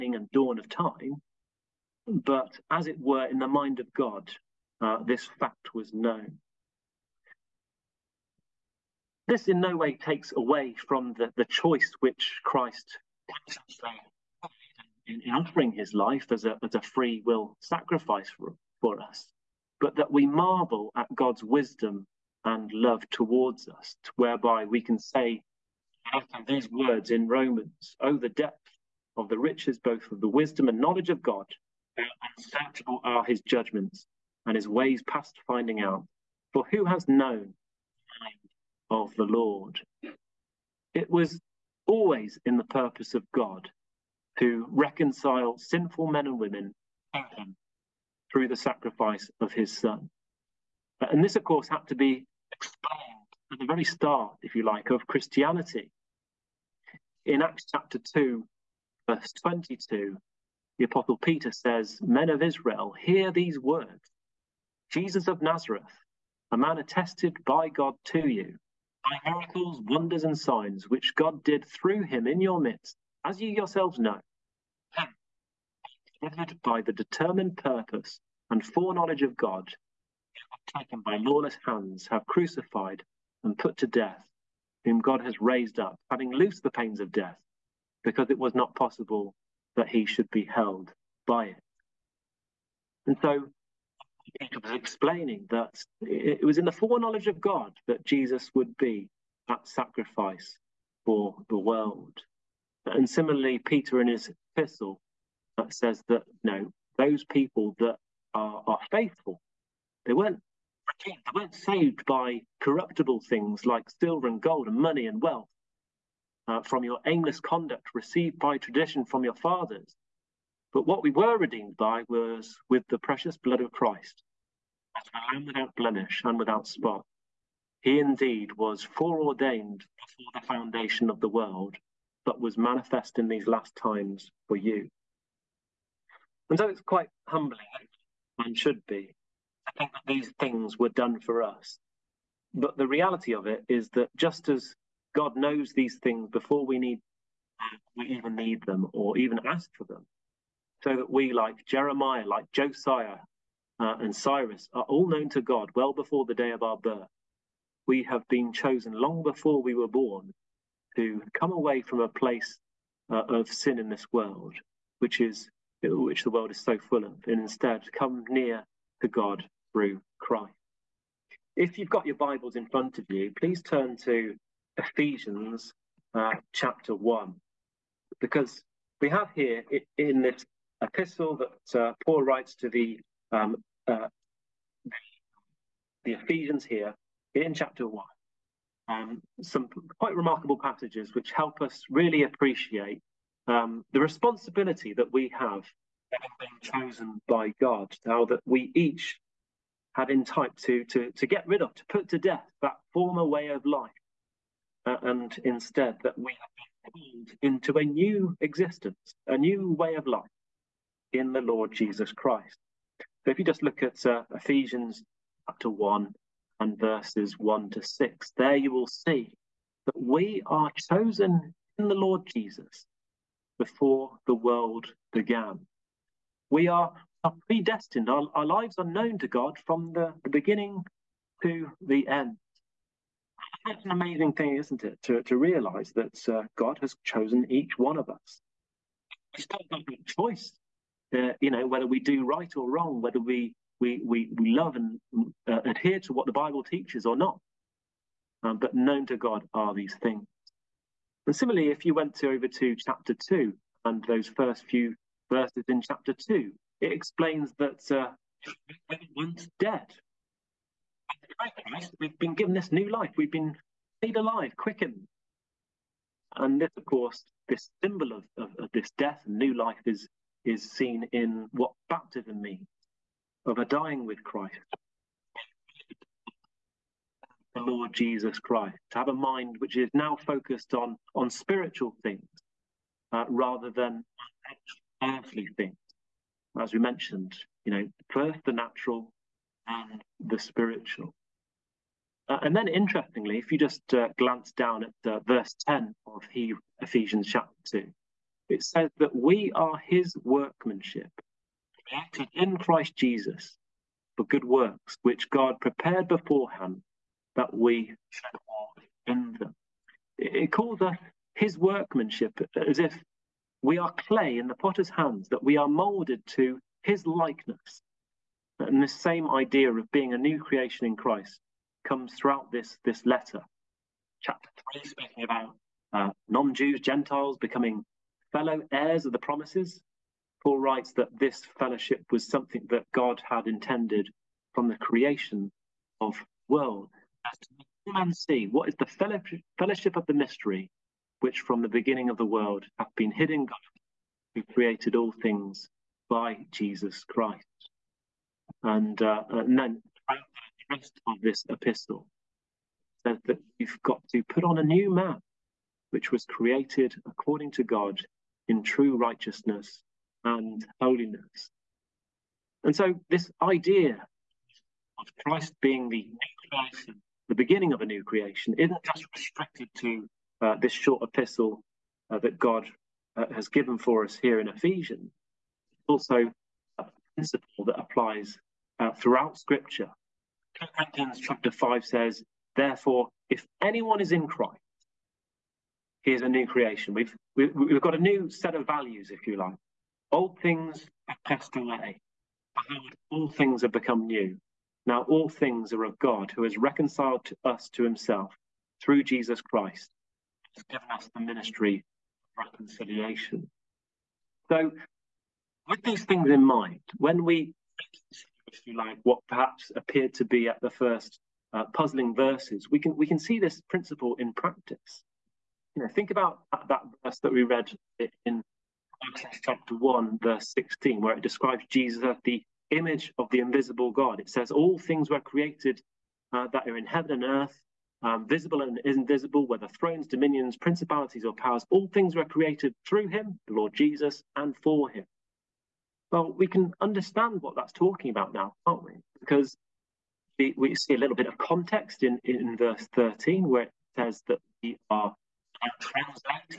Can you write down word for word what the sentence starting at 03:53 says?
That's an amazing thing, isn't it, to, to realize that uh, God has chosen each one of us.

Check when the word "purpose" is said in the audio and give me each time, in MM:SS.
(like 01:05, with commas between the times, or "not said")
00:42, 01:17.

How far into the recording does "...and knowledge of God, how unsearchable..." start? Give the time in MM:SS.
00:30.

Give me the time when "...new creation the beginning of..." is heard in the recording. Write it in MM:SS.
06:06.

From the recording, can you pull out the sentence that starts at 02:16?
And so it's quite humbling, and should be, I think that these things were done for us.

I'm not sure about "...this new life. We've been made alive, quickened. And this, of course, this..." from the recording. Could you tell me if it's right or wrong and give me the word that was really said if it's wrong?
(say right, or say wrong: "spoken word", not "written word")
right.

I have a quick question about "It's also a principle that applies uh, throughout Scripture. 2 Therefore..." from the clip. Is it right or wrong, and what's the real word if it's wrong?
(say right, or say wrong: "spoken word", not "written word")
wrong: "Corinthians", not "Therefore".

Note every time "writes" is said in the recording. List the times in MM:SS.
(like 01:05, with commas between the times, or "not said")
03:02, 05:30.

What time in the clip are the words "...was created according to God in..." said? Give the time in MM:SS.
05:56.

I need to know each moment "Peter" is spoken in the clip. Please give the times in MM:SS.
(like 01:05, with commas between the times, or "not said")
01:01, 01:34, 01:43.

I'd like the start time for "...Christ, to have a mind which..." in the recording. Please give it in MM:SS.
04:38.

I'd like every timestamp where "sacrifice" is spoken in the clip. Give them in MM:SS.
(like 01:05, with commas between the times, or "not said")
00:17, 00:48, 01:39.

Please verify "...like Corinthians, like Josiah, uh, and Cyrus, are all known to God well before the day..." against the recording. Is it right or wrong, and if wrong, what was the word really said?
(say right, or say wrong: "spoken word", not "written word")
wrong: "Jeremiah", not "Corinthians".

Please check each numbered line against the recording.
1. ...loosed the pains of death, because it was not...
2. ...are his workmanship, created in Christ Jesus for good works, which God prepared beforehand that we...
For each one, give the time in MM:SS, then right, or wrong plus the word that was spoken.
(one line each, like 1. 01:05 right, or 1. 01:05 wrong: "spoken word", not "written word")
1. 01:26 right
2. 04:59 right.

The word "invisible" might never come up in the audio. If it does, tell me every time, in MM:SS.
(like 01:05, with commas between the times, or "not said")
07:03, 07:08.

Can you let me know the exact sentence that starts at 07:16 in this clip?
Well, we can understand what that's talking about now, can't we?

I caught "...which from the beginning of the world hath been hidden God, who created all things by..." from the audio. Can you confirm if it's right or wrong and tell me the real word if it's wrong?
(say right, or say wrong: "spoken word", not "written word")
right.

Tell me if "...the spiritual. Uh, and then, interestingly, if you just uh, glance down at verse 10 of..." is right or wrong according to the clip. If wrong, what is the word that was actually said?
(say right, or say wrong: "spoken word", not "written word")
right.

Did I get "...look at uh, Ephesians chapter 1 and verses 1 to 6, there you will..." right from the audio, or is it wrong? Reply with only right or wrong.
right.